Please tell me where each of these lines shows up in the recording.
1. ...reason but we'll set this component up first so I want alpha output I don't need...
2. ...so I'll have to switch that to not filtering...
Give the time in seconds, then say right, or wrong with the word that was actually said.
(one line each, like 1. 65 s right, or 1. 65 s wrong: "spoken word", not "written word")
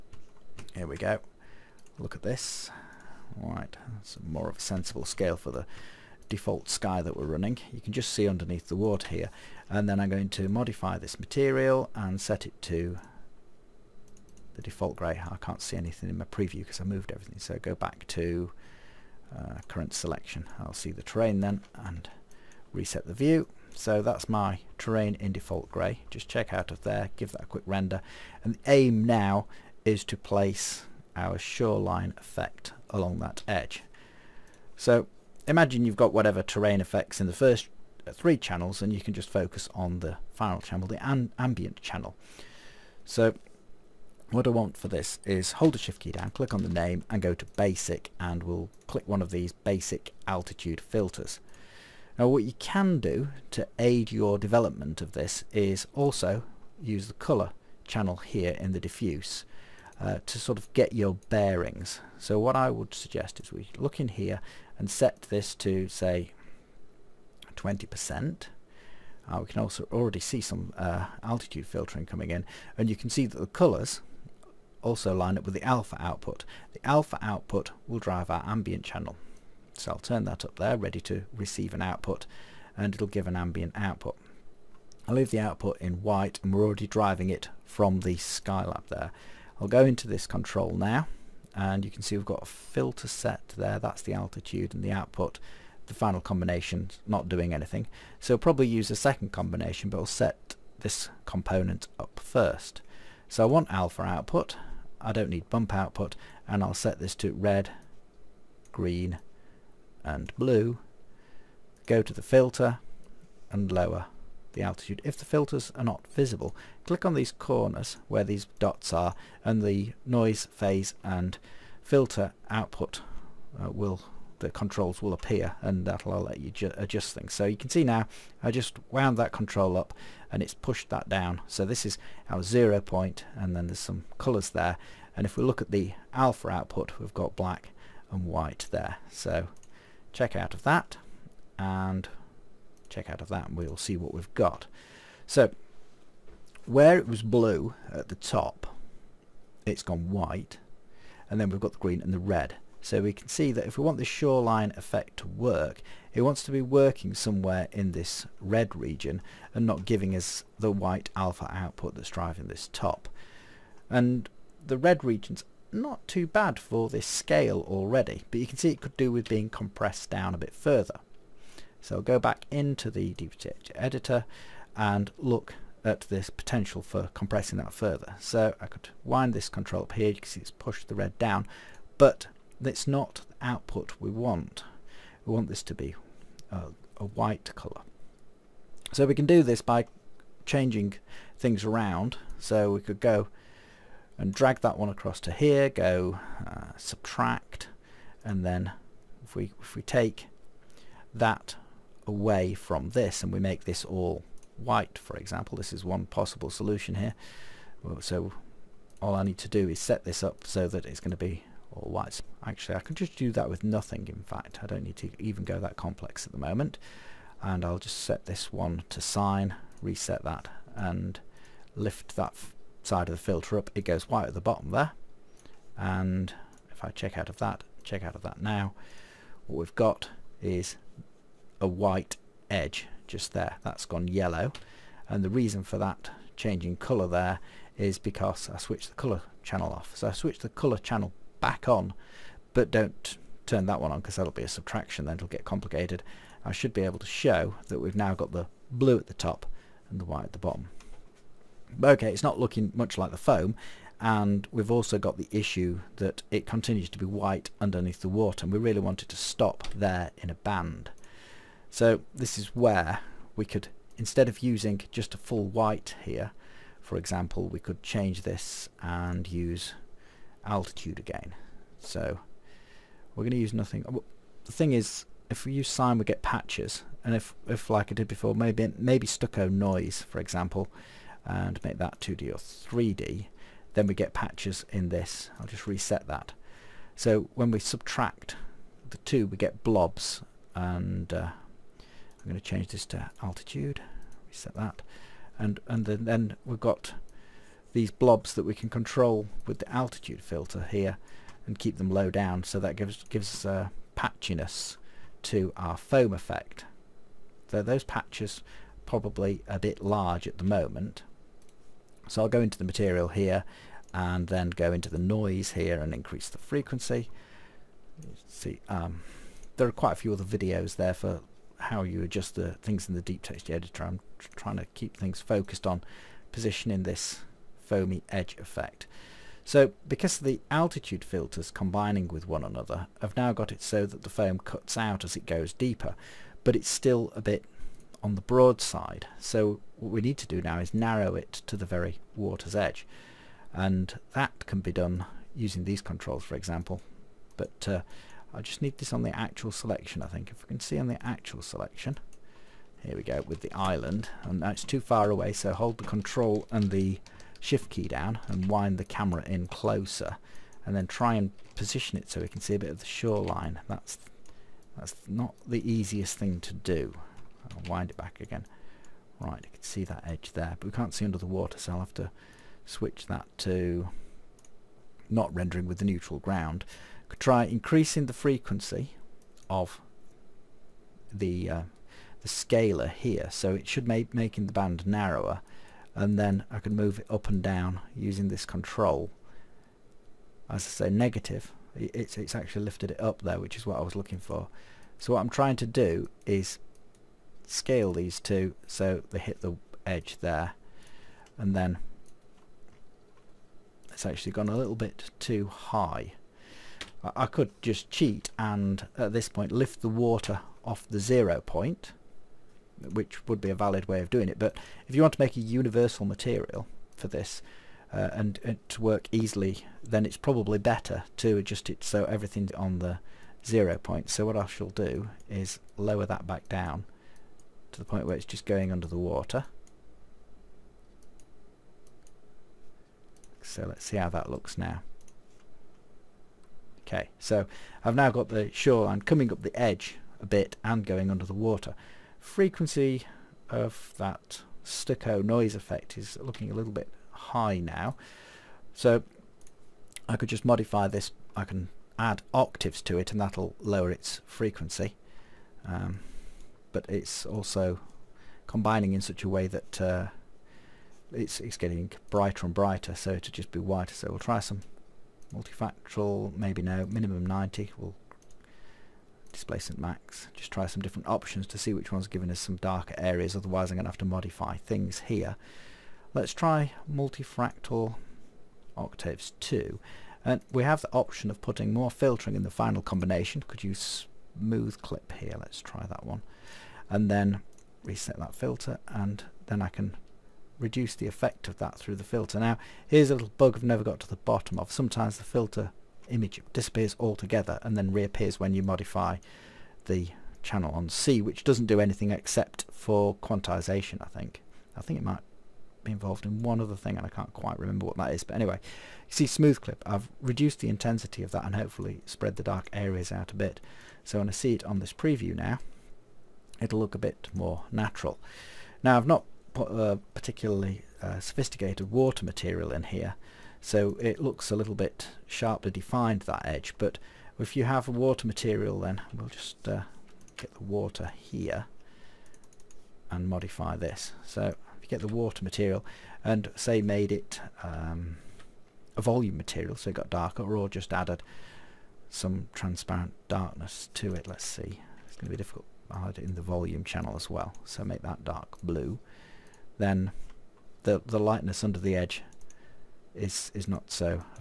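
1. 99 s wrong: "combination", not "reason"
2. 371 s wrong: "rendering", not "filtering".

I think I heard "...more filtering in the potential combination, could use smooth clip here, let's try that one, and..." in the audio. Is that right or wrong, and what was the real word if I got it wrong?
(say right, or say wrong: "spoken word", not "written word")
wrong: "final", not "potential".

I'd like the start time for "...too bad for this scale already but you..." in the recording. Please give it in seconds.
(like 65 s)
166 s.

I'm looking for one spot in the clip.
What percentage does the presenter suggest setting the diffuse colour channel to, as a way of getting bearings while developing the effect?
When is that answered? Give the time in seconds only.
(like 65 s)
67 s.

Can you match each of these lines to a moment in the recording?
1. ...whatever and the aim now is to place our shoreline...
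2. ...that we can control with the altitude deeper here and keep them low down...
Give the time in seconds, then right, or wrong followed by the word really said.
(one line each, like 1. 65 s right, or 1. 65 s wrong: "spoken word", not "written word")
1. 27 s wrong: "render", not "whatever"
2. 298 s wrong: "filter", not "deeper".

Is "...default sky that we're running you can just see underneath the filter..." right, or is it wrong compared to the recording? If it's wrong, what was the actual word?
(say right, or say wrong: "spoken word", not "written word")
wrong: "water", not "filter".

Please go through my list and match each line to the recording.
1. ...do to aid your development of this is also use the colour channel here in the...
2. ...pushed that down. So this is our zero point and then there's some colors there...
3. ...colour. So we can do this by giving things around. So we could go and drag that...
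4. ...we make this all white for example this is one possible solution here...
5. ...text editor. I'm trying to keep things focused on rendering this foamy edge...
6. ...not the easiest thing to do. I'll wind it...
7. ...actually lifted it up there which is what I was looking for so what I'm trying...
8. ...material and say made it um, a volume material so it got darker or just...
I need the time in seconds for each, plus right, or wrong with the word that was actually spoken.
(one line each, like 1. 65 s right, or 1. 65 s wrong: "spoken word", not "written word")
1. 52 s right
2. 130 s right
3. 187 s wrong: "changing", not "giving"
4. 203 s right
5. 323 s wrong: "positioning", not "rendering"
6. 365 s right
7. 392 s right
8. 535 s right.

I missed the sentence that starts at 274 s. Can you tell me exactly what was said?
The thing is, if we use sine, we get patches.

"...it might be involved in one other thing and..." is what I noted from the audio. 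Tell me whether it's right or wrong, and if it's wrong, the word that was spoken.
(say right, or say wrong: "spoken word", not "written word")
right.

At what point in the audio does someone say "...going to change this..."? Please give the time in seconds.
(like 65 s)
292 s.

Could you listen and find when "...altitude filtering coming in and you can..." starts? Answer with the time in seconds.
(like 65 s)
71 s.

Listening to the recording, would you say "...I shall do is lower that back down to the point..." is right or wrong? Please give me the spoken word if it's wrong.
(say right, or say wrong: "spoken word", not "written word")
right.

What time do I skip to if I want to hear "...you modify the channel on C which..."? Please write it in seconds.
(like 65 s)
498 s.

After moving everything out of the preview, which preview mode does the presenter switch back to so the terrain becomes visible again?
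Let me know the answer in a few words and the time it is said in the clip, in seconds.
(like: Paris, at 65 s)
current selection, at 19 s.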